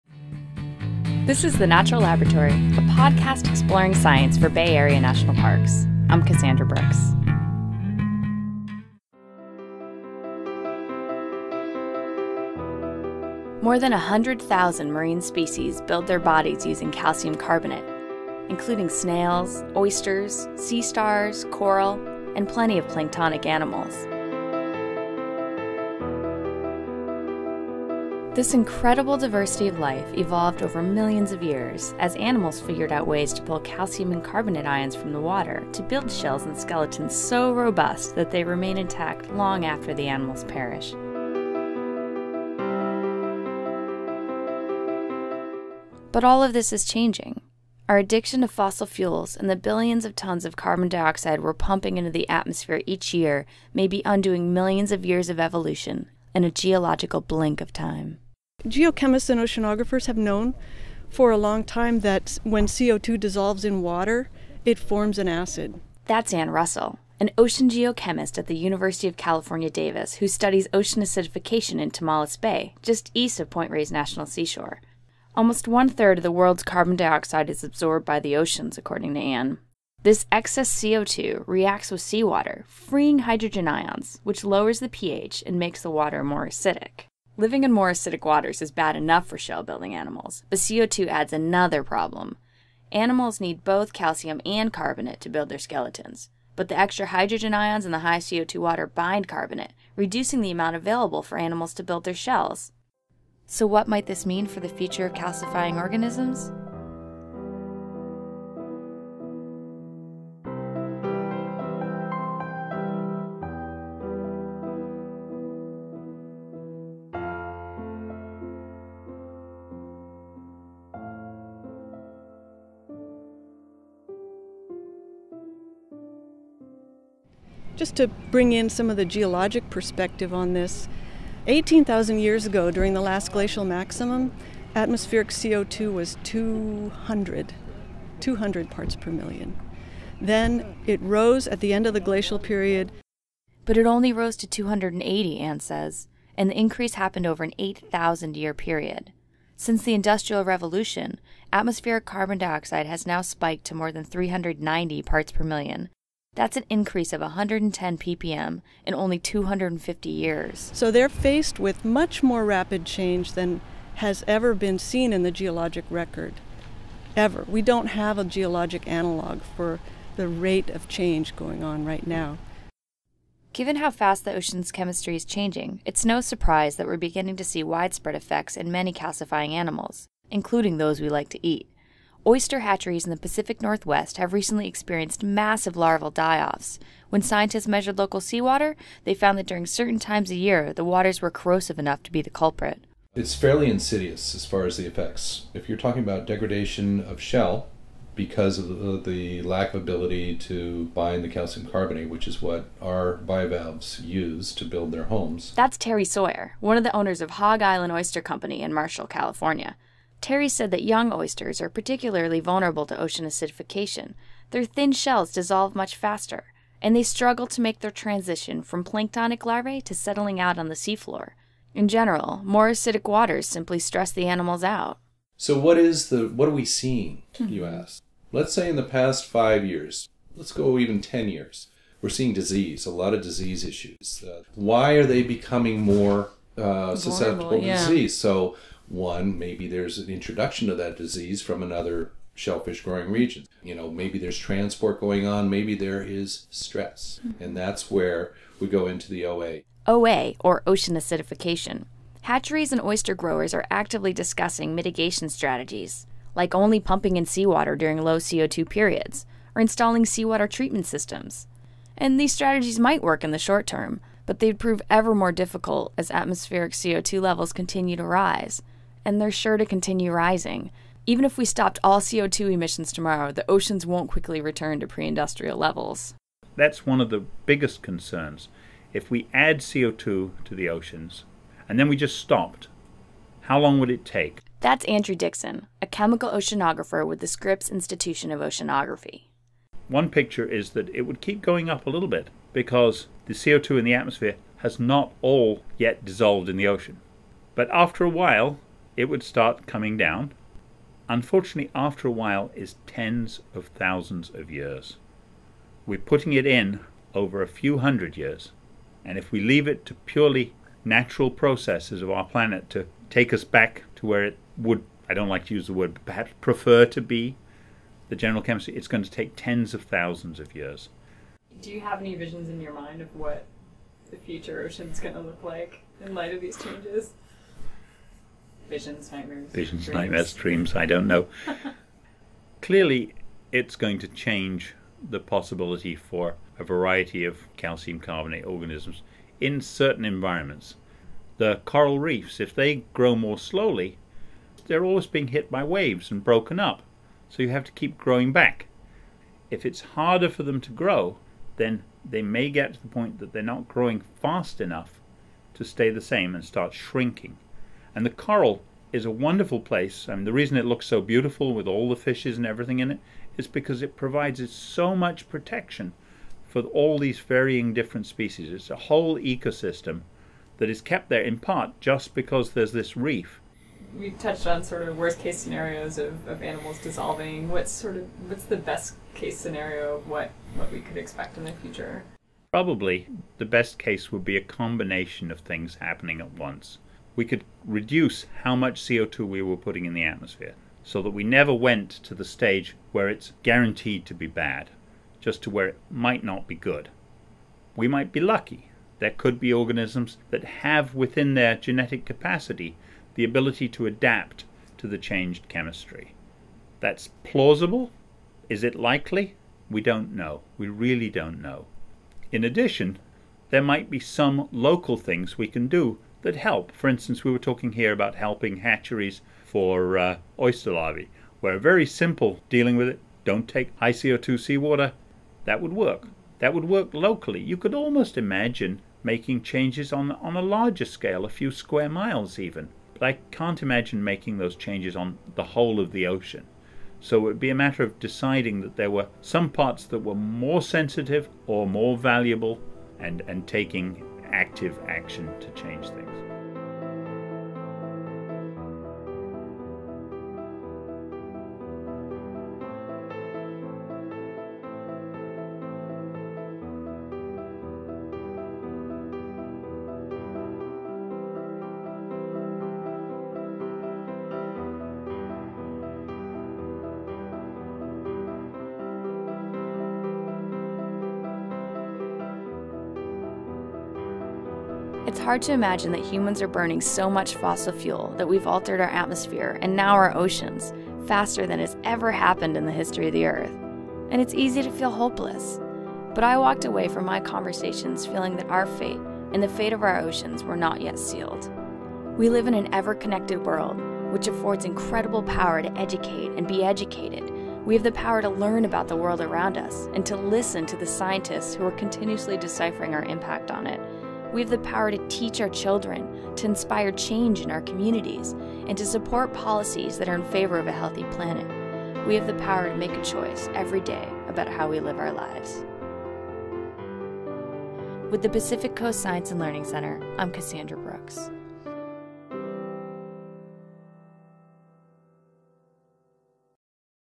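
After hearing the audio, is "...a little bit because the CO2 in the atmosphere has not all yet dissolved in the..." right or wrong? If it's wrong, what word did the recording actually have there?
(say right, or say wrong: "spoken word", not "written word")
right.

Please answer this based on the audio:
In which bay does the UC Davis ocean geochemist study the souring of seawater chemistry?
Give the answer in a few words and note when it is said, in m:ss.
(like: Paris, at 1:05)
Tomales Bay, at 1:11.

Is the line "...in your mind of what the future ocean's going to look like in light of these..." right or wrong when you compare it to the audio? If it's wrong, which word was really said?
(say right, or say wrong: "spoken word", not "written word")
right.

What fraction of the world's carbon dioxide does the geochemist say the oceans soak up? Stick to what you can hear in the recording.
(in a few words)
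Almost one third.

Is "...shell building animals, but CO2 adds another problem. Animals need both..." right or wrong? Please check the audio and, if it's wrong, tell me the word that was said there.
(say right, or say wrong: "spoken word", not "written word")
right.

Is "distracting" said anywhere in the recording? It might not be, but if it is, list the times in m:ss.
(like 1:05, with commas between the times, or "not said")
not said.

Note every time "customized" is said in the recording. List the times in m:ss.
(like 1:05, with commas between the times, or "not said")
not said.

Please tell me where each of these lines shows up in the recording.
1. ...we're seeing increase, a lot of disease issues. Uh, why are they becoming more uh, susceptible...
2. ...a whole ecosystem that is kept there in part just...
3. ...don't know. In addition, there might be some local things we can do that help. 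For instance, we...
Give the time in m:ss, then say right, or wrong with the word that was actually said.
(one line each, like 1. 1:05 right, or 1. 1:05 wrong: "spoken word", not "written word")
1. 3:52 wrong: "disease", not "increase"
2. 6:08 right
3. 6:51 right.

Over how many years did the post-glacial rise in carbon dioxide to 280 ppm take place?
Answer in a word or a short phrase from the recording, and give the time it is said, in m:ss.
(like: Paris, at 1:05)
8,000 years, at 2:27.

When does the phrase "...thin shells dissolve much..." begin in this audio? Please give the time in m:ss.
3:34.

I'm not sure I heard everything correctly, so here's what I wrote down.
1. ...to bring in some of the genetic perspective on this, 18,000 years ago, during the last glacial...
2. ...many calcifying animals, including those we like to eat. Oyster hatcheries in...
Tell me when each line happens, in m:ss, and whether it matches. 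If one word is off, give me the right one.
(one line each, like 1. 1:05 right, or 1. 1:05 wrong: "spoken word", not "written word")
1. 2:07 wrong: "geologic", not "genetic"
2. 2:58 right.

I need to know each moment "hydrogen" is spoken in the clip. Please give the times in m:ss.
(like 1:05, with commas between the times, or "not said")
1:23, 1:37.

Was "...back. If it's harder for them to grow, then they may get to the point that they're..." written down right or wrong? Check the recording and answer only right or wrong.
right.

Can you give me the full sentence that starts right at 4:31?
Even if we stopped all CO2 emissions tomorrow, the oceans won't quickly return to pre industrial levels.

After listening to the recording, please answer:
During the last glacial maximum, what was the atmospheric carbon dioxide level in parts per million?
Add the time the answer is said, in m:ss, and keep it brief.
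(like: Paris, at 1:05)
200, at 2:18.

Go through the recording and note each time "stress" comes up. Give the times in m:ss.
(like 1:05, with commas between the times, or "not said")
3:43, 4:06.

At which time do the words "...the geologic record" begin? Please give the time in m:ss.
2:45.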